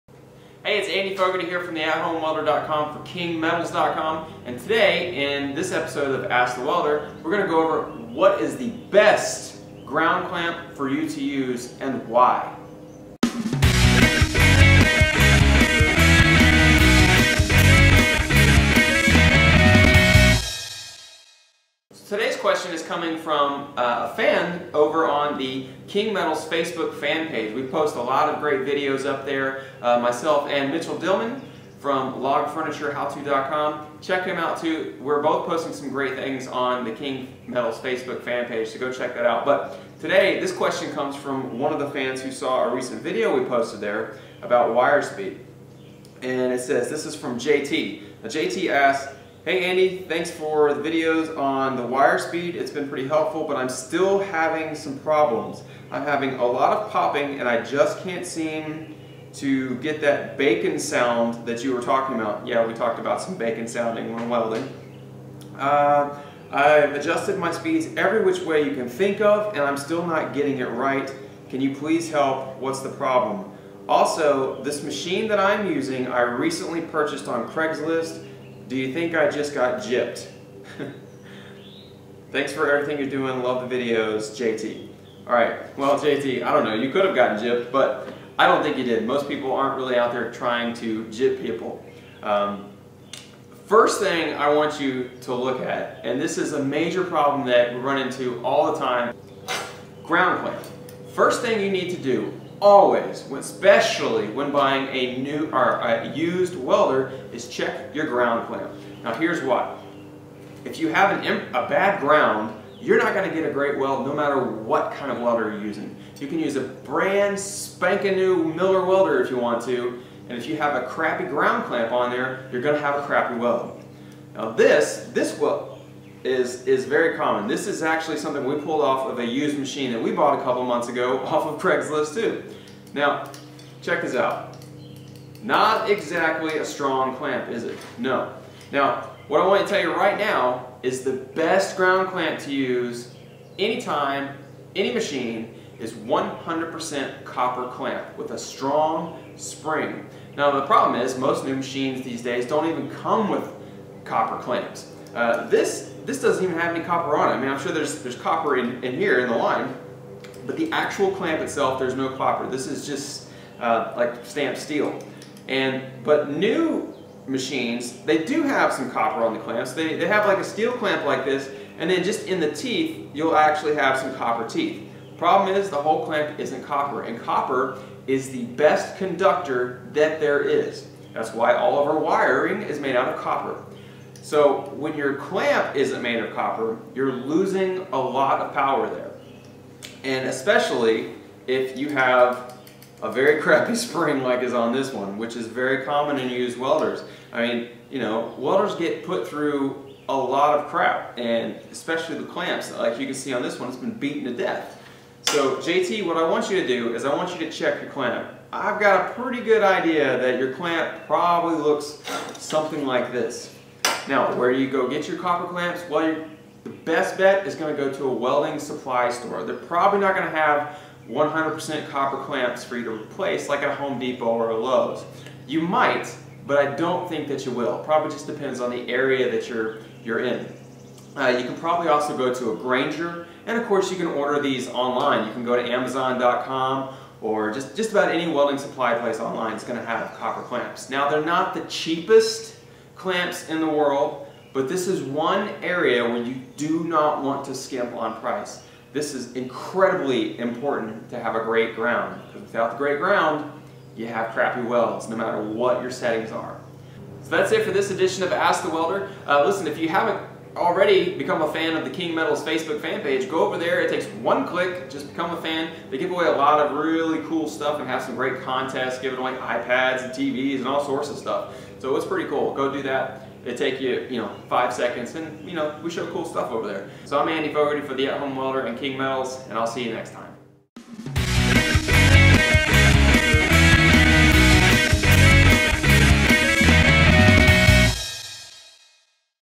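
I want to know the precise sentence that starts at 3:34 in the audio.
Now, where do you go get your copper clamps?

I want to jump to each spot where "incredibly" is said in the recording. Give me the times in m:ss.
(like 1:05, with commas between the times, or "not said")
4:09.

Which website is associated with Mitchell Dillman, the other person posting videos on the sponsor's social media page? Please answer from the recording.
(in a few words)
logfurniturehowto.com.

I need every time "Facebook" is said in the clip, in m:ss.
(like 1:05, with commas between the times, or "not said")
0:26, 0:37, 4:22.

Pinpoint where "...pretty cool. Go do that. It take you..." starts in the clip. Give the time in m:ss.
4:32.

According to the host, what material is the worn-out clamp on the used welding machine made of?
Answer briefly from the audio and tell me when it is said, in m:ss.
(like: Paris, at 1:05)
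Stamped steel, at 2:44.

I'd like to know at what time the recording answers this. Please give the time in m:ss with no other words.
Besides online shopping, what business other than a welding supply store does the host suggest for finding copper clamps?
3:52.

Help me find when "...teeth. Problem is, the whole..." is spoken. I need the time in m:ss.
2:54.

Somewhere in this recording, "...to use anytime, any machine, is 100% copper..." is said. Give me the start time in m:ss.
2:22.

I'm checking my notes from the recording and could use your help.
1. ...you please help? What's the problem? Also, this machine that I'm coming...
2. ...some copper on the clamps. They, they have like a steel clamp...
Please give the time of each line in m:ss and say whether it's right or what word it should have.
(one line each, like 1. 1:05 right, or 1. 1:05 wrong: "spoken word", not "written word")
1. 1:11 wrong: "using", not "coming"
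2. 2:48 right.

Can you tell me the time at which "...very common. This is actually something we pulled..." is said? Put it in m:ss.
2:06.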